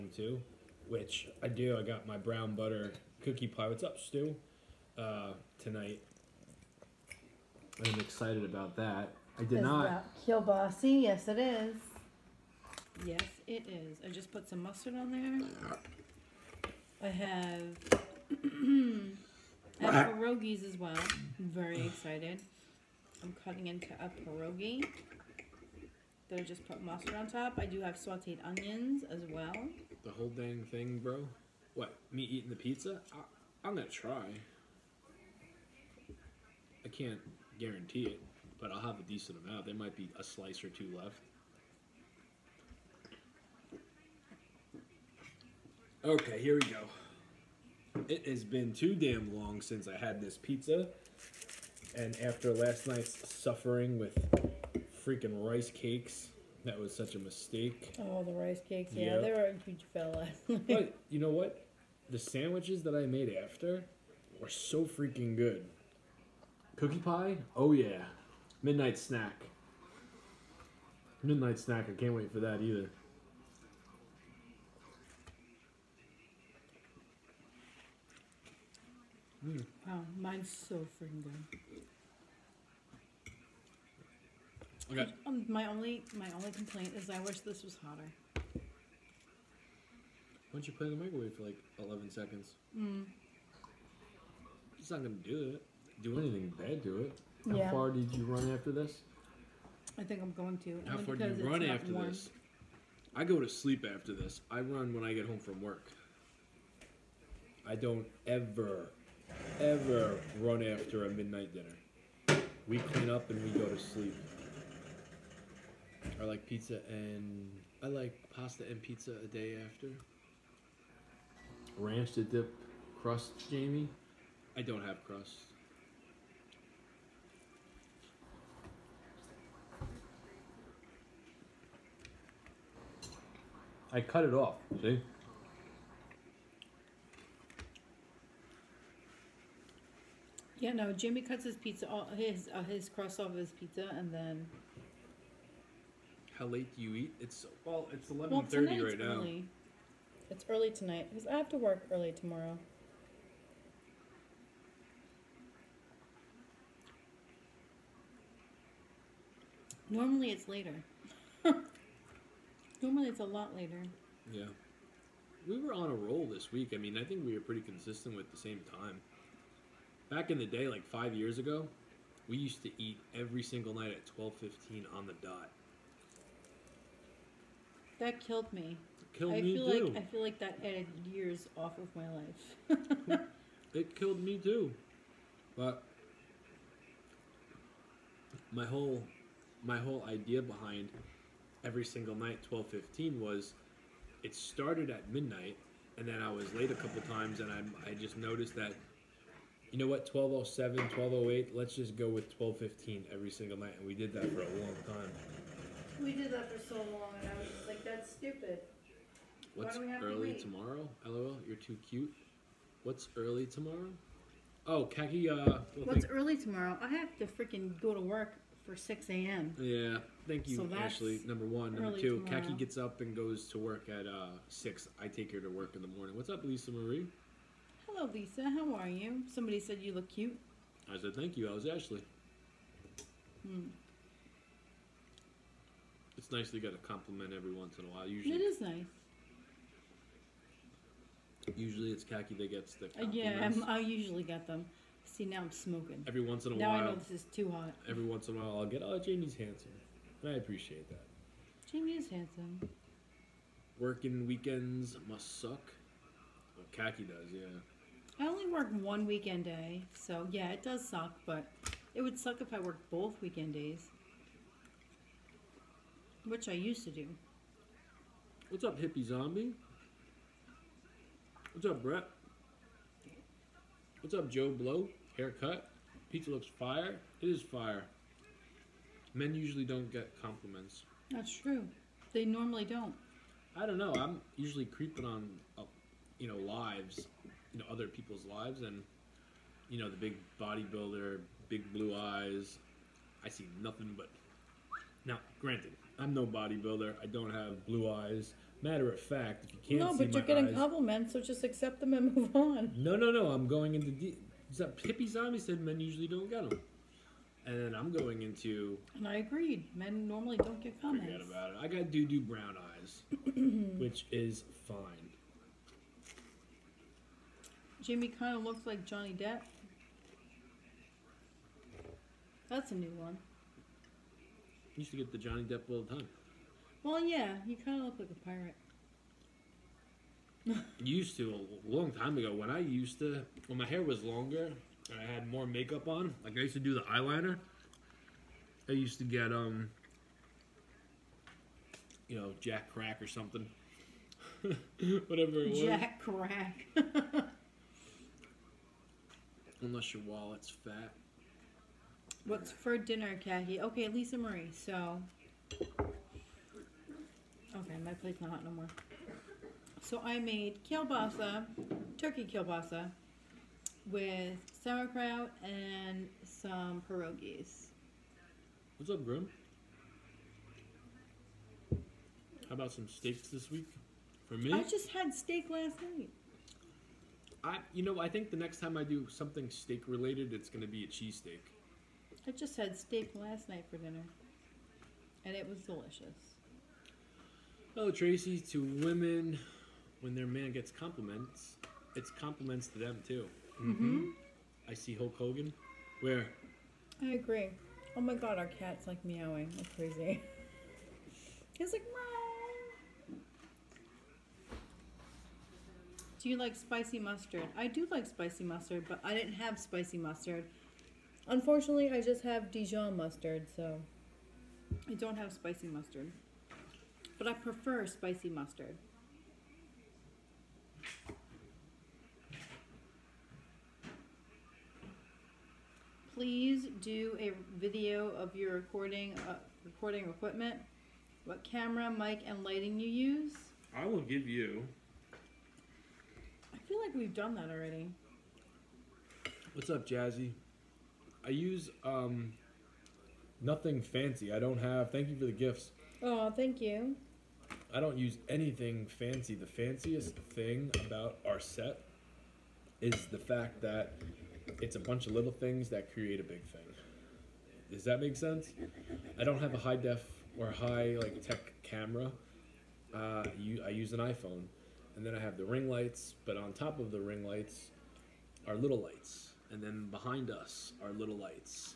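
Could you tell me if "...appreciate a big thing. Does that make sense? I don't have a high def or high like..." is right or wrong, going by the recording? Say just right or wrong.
wrong.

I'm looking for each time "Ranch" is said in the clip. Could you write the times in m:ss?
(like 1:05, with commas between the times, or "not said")
2:01.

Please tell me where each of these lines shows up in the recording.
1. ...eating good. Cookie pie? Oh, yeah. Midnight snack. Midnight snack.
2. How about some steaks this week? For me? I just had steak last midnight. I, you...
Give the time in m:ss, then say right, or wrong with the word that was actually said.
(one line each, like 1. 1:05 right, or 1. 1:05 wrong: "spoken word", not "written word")
1. 1:04 wrong: "freaking", not "eating"
2. 6:12 wrong: "night", not "midnight".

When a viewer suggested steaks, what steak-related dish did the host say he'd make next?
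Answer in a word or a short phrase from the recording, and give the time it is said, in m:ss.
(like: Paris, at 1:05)
cheesesteak, at 6:20.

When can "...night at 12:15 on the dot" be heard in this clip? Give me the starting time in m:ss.
2:53.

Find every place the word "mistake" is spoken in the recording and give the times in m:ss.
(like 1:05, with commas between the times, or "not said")
0:57.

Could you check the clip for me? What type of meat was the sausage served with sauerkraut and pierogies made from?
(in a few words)
turkey.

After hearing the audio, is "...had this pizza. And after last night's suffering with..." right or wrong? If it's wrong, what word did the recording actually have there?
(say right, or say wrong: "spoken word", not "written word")
right.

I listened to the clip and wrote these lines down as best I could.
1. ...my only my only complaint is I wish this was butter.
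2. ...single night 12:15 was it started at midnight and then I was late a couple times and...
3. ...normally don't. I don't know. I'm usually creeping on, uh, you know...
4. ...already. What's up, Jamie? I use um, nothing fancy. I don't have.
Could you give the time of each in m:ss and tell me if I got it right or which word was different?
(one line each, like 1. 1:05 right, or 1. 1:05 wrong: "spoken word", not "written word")
1. 1:25 wrong: "hotter", not "butter"
2. 3:11 right
3. 4:42 right
4. 7:17 wrong: "Jazzy", not "Jamie".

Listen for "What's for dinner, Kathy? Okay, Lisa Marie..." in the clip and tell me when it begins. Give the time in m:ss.
5:52.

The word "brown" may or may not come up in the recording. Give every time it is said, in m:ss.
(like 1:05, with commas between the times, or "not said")
0:02, 5:12.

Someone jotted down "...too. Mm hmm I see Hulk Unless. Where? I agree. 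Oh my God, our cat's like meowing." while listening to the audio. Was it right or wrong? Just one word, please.
wrong.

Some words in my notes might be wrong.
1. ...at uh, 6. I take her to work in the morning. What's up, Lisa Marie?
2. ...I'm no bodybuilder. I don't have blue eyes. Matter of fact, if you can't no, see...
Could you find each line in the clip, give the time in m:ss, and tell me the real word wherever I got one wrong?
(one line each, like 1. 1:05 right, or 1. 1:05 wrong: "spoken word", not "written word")
1. 3:43 right
2. 4:55 right.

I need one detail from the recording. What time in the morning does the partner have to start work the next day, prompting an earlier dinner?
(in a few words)
6 a.m.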